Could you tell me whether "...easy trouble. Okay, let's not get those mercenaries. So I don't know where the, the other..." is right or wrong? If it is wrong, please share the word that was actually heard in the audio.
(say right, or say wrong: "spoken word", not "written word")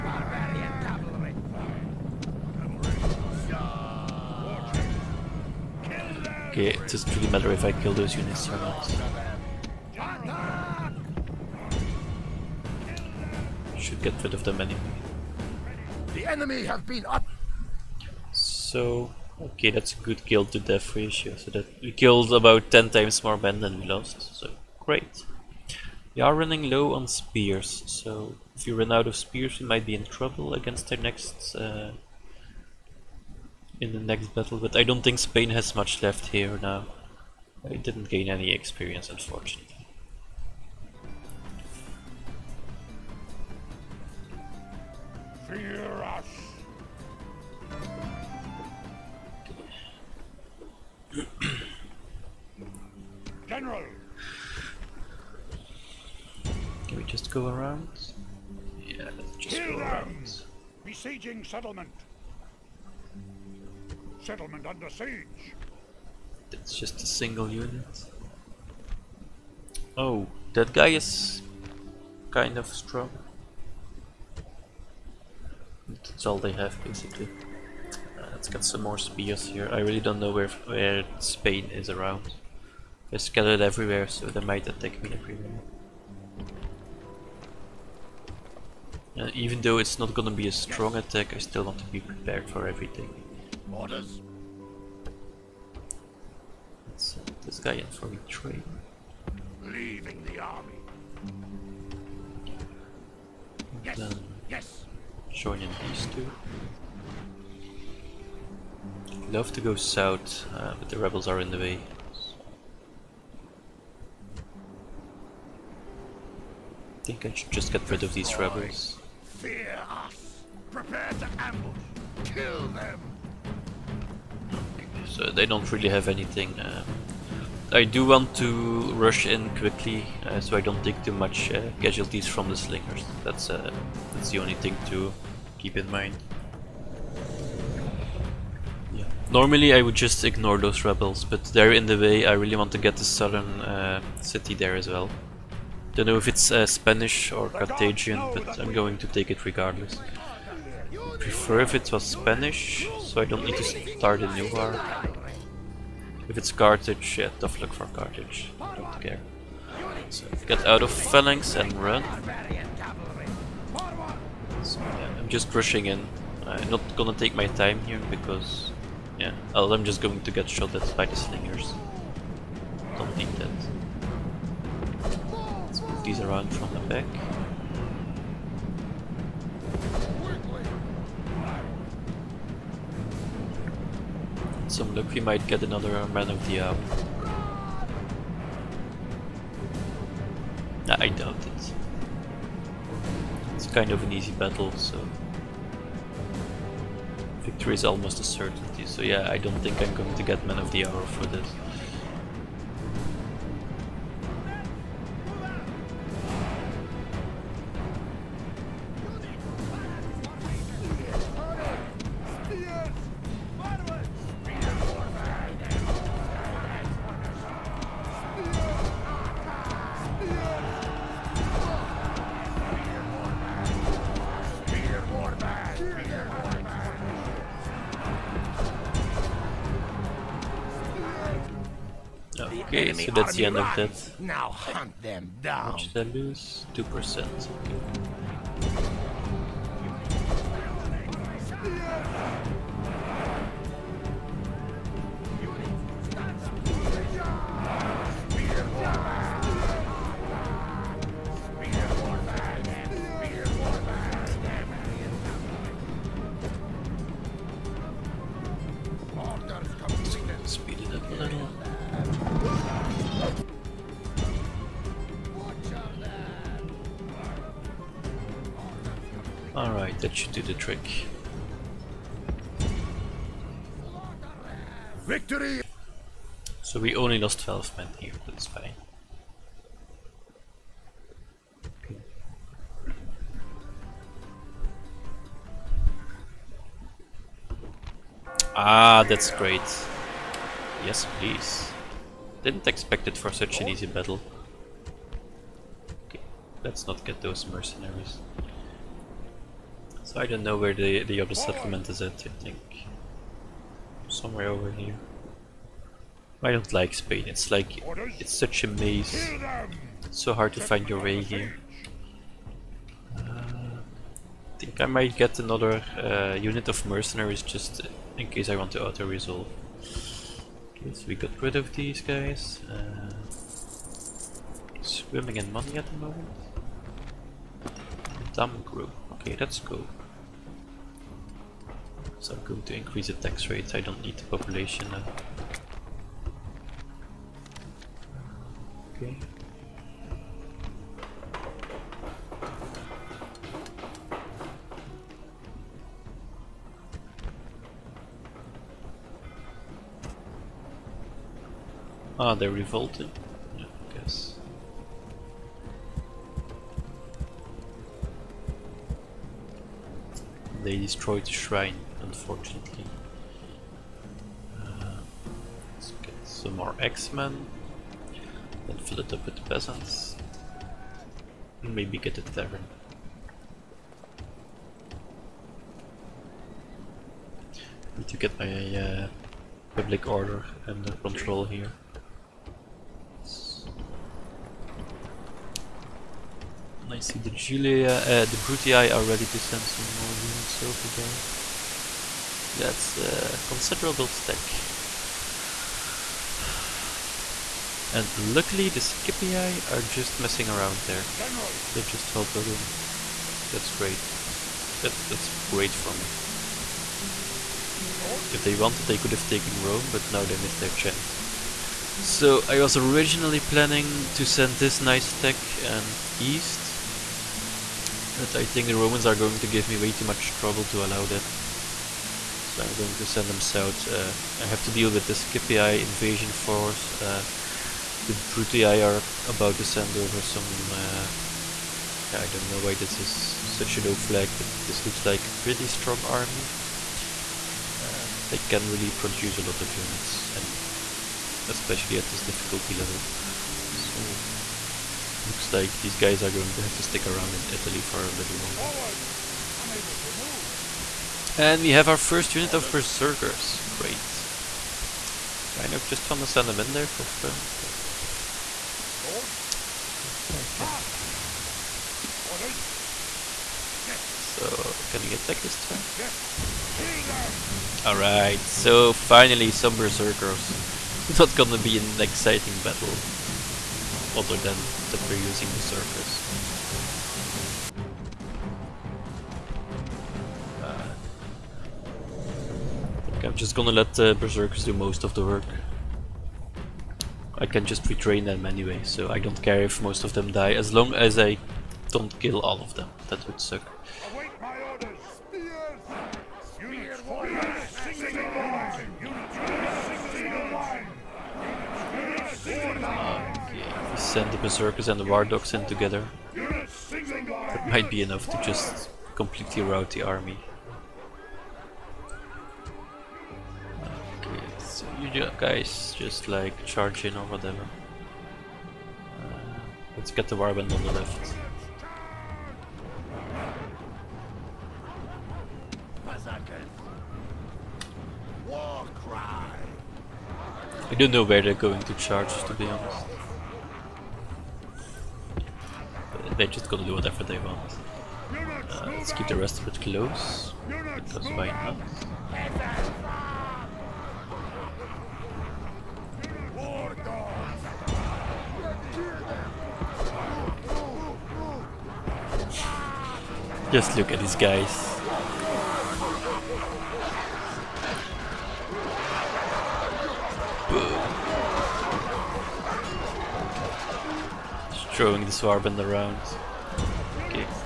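wrong: "battle", not "trouble".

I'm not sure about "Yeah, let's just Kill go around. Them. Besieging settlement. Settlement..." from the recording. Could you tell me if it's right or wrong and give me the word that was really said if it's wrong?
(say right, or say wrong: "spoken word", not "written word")
right.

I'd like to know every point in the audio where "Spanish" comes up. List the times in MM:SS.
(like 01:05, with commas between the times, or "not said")
02:26, 02:32.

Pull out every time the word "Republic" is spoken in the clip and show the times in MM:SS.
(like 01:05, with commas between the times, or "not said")
not said.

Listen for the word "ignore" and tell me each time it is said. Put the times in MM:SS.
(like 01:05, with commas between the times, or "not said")
02:20.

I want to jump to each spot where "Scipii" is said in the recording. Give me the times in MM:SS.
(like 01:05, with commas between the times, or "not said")
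06:38, 07:05.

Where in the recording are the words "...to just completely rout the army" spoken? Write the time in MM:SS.
08:28.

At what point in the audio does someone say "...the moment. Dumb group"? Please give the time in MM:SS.
05:25.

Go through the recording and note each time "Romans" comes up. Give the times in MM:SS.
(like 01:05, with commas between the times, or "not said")
06:58.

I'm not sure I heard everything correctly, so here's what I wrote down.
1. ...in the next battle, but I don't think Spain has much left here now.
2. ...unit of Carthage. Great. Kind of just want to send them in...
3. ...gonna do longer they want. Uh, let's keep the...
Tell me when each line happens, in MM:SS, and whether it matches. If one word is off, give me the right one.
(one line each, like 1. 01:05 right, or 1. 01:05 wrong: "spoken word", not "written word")
1. 00:33 right
2. 07:32 wrong: "Berserkers", not "Carthage"
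3. 08:56 wrong: "whatever", not "longer".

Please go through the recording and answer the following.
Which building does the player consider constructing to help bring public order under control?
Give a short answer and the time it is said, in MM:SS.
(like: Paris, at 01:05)
A tavern, at 06:12.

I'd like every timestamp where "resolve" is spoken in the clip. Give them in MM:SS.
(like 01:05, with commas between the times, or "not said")
05:18.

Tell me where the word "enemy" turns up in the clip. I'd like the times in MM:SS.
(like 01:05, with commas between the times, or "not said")
00:16.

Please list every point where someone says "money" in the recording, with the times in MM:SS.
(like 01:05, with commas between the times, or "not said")
05:25.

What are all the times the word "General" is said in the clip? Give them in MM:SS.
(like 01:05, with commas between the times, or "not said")
00:53, 06:41.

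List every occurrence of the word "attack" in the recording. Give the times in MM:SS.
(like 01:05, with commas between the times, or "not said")
01:24, 01:30, 07:45.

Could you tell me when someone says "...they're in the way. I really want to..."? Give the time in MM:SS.
02:21.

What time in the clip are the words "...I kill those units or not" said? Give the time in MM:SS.
00:07.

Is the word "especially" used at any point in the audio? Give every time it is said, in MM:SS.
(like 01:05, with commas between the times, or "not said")
07:21.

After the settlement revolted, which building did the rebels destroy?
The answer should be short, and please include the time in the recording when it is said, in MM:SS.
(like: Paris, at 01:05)
The shrine, at 06:01.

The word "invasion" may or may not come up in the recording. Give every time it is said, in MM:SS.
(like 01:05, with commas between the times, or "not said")
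07:05.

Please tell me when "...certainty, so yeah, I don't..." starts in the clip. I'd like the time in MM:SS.
03:18.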